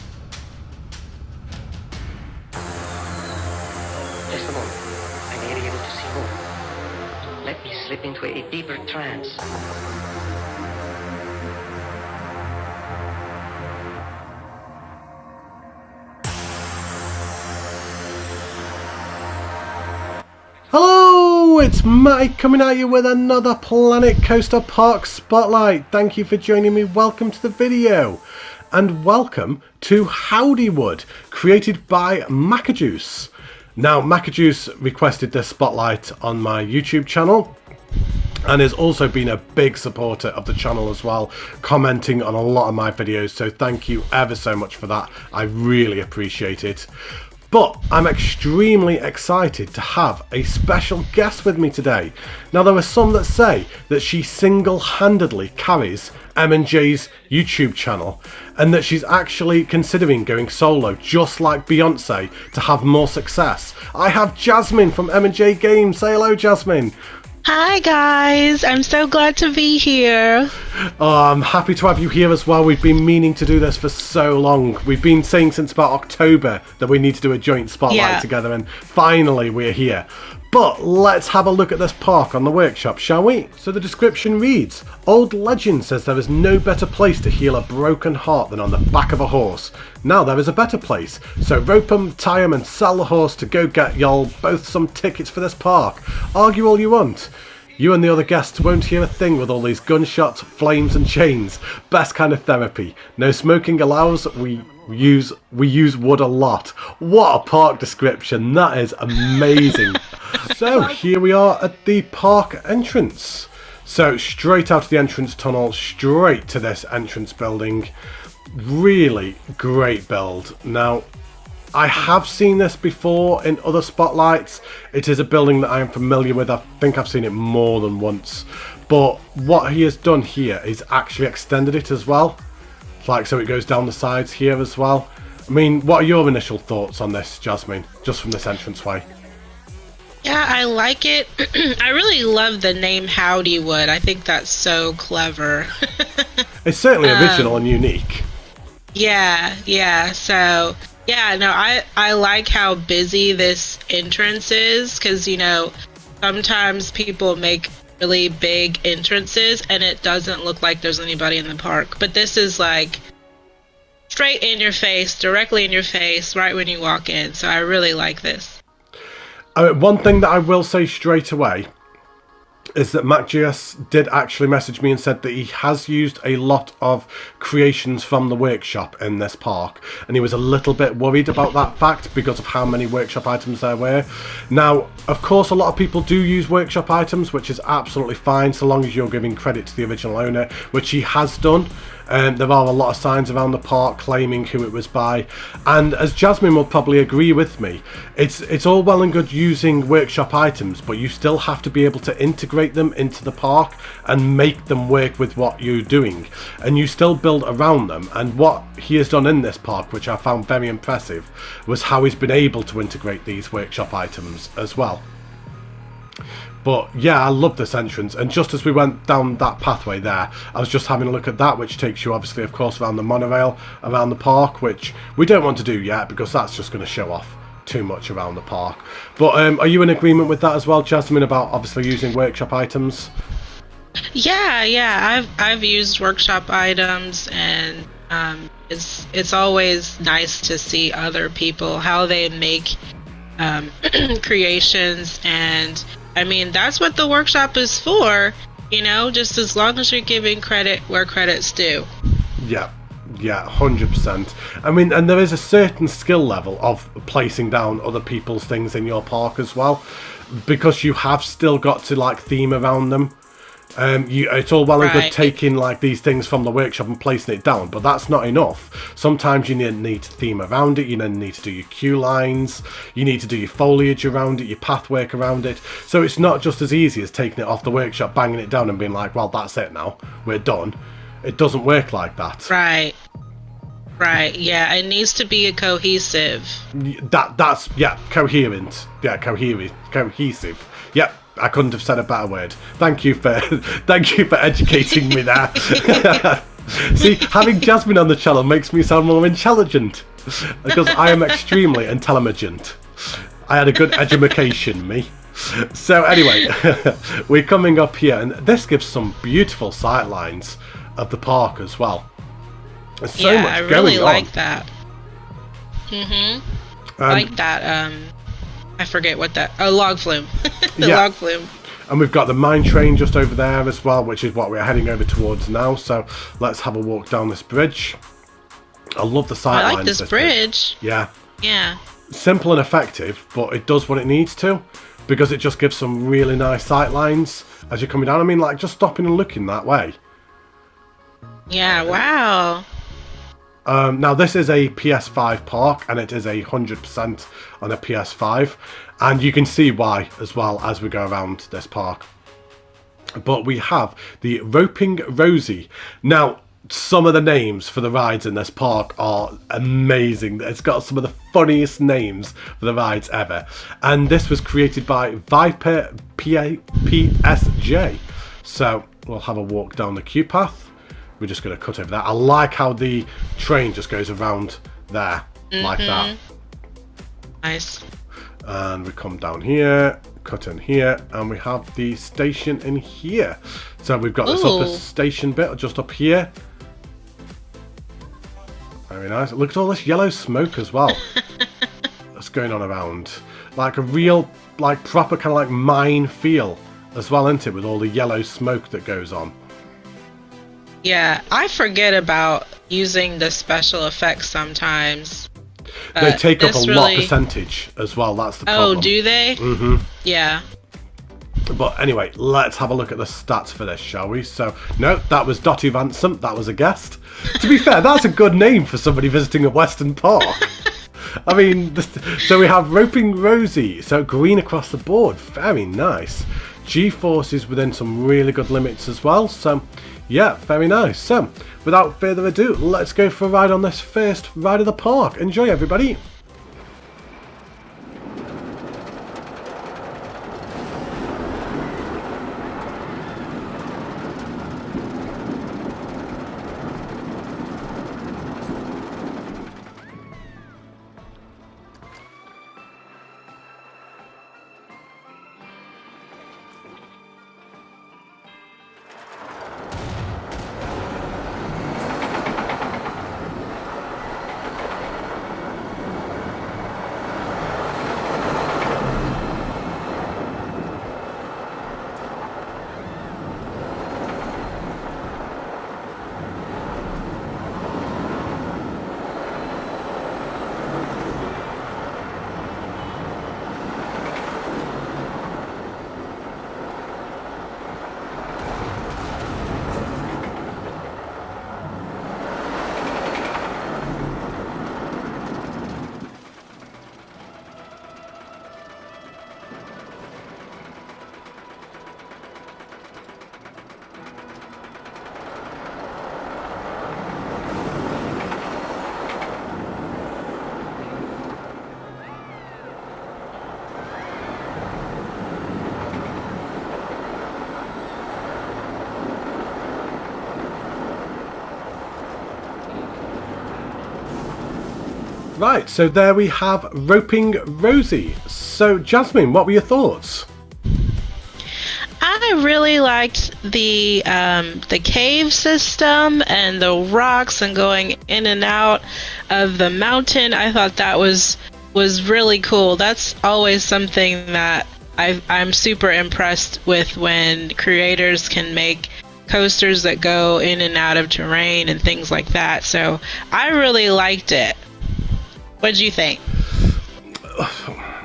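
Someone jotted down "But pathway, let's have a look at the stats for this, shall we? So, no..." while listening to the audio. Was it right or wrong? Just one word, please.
wrong.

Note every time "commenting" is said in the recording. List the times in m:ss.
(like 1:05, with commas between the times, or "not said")
0:41.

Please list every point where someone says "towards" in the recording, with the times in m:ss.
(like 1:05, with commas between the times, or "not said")
5:25.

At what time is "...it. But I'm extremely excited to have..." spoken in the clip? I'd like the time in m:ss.
0:46.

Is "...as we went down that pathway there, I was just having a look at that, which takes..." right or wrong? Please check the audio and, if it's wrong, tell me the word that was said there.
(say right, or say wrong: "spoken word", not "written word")
right.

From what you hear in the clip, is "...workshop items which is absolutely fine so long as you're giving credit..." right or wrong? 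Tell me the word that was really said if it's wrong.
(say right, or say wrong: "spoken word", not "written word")
right.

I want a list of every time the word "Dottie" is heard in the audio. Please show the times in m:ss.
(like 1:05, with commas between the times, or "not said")
6:55.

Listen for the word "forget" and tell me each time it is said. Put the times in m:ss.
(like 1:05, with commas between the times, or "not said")
5:18, 6:41.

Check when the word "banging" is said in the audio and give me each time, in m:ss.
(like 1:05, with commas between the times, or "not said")
4:38.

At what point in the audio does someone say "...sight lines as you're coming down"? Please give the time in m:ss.
5:36.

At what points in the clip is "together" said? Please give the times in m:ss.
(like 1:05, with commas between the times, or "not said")
1:18.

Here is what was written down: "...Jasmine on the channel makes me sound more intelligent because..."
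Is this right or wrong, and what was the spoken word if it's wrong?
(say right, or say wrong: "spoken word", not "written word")
right.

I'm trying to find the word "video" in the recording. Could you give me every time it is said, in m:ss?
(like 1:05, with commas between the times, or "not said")
0:27, 0:42.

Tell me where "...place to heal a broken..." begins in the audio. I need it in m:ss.
1:26.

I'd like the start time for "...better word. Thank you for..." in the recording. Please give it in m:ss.
4:52.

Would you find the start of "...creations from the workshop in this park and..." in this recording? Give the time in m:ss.
2:57.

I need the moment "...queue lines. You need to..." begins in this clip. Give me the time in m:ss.
4:31.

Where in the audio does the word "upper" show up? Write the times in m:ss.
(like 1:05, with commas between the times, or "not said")
6:24.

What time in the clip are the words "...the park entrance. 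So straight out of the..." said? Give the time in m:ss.
1:51.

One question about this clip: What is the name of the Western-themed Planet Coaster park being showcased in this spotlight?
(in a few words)
Howdywood.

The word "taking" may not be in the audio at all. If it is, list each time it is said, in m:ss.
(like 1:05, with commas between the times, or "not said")
4:25, 4:37.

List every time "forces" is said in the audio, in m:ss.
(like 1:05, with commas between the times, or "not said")
7:06.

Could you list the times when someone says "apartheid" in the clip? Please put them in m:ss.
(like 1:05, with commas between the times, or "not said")
not said.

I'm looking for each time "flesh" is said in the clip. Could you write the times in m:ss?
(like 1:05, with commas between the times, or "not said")
not said.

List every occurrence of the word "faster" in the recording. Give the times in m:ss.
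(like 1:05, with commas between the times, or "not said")
not said.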